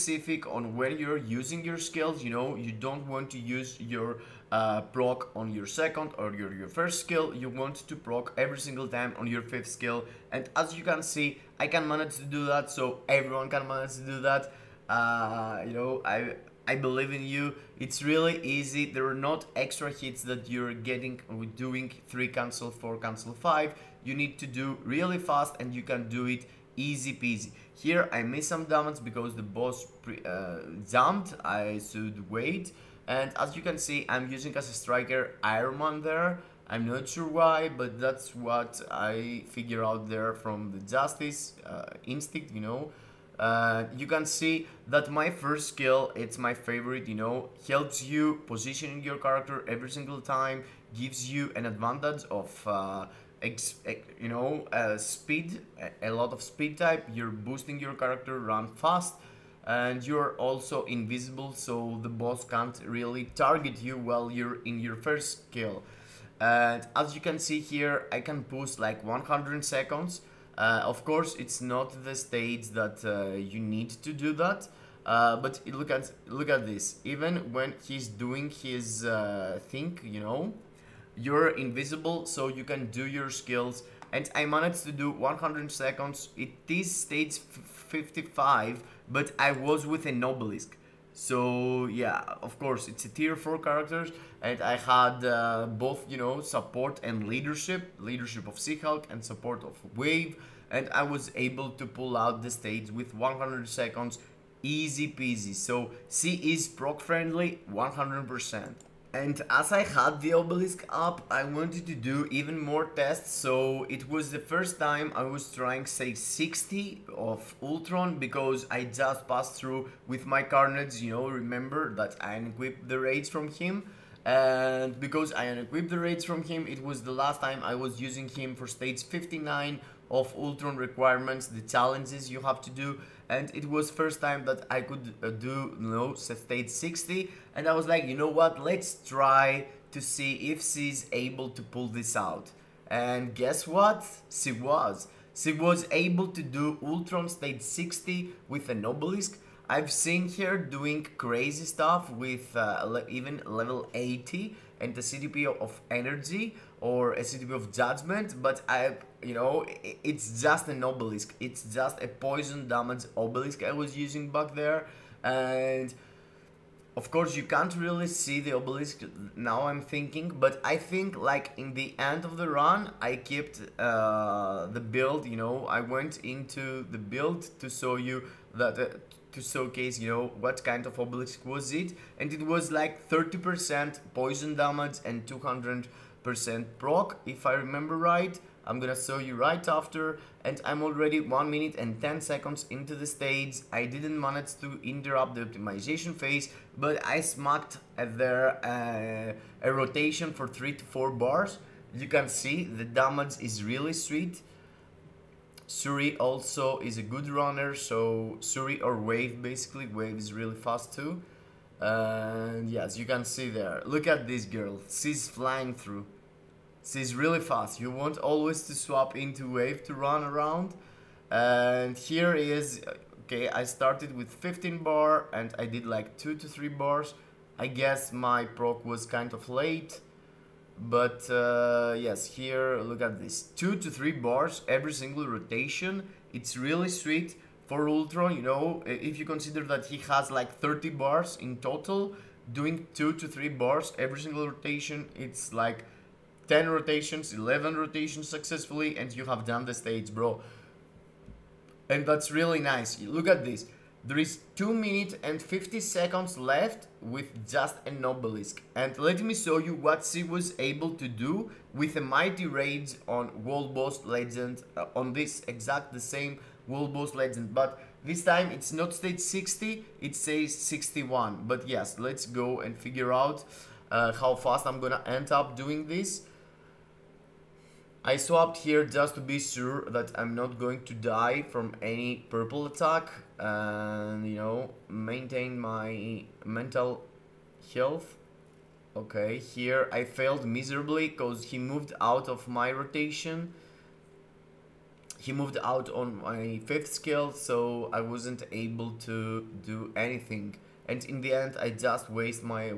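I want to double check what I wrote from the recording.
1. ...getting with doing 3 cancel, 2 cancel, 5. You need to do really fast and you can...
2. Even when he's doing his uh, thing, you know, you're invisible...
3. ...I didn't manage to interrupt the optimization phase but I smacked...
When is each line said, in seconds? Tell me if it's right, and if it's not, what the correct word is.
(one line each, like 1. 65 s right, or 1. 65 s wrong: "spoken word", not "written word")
1. 20 s wrong: "4", not "2"
2. 77 s right
3. 193 s right.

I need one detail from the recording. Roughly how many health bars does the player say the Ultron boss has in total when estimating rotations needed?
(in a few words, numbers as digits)
30.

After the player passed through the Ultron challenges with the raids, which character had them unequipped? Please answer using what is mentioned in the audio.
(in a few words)
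Carnage.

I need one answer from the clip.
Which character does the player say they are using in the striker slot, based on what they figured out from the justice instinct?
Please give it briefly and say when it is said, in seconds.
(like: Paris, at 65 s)
Iron Man, at 35 s.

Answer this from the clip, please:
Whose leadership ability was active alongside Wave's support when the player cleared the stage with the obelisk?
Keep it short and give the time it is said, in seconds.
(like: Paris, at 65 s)
Seahawk, at 98 s.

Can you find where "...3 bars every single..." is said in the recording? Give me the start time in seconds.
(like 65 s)
233 s.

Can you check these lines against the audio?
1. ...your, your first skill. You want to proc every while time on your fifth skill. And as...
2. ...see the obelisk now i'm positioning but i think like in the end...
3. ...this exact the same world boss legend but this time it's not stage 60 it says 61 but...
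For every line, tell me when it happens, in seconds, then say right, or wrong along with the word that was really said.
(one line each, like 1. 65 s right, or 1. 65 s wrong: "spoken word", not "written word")
1. 6 s wrong: "single", not "while"
2. 168 s wrong: "thinking", not "positioning"
3. 265 s right.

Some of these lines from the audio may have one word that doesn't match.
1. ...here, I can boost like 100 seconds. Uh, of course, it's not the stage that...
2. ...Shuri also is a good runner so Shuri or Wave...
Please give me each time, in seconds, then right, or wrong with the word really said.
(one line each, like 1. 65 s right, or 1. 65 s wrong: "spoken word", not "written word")
1. 67 s right
2. 205 s right.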